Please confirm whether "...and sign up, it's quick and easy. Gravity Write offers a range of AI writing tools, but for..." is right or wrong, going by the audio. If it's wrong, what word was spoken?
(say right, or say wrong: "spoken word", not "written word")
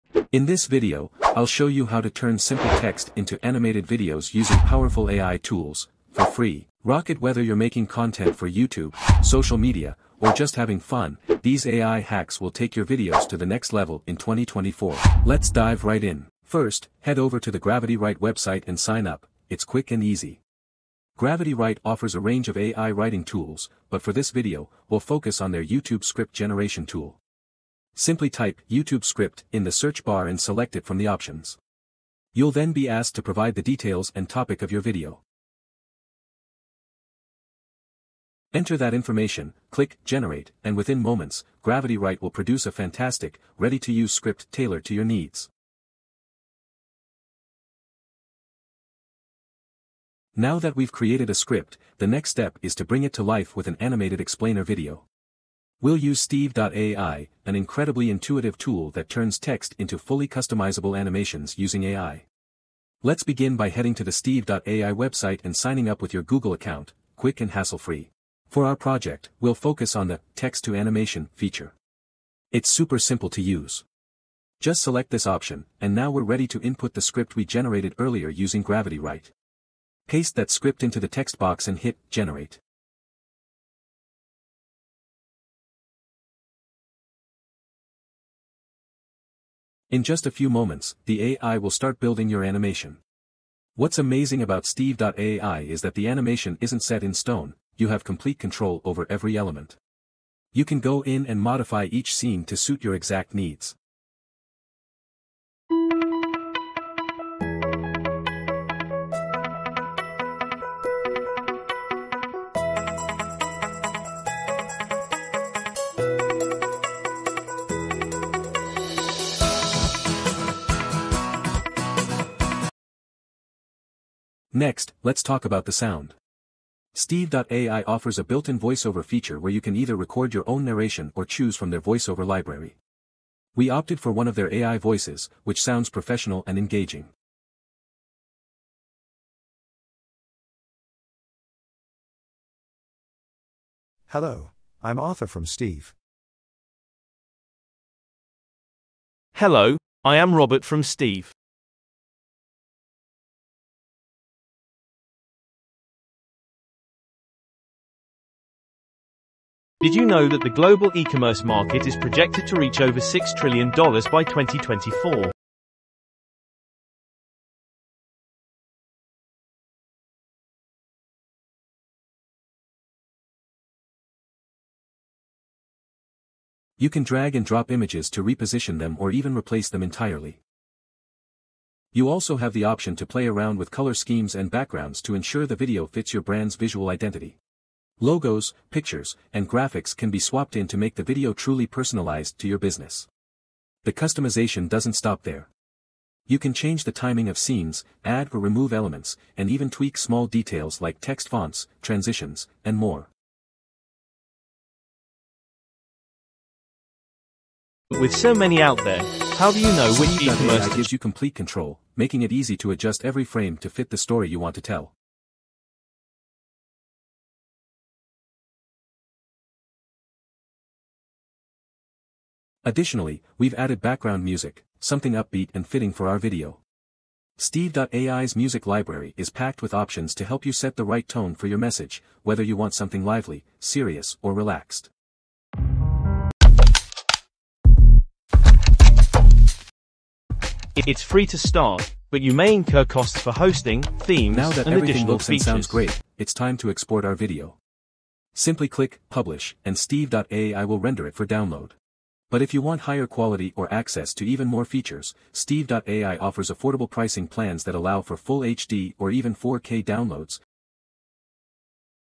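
right.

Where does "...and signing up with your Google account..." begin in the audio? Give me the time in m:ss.
1:05.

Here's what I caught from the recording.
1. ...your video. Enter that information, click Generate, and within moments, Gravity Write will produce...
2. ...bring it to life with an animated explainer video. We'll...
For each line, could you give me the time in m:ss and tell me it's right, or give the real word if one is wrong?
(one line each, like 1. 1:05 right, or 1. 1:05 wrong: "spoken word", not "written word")
1. 0:34 right
2. 0:52 right.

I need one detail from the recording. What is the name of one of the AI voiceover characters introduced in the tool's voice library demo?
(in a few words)
Arthur.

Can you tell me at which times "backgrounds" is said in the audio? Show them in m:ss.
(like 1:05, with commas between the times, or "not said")
3:04, 3:43.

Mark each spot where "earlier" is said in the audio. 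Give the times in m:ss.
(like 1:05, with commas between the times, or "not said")
1:17.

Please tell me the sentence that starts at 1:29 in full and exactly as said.
In just a few moments, the AI will start building your animation.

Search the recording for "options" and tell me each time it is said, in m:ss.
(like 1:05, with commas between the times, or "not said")
0:31, 1:15, 3:02, 3:49.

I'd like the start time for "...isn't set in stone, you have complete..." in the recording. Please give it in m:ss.
1:36.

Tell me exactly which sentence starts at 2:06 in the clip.
Steve.ai offers a built-in voiceover feature where you can either record your own narration or choose from their voiceover library.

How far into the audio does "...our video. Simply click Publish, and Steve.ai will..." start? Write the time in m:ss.
4:07.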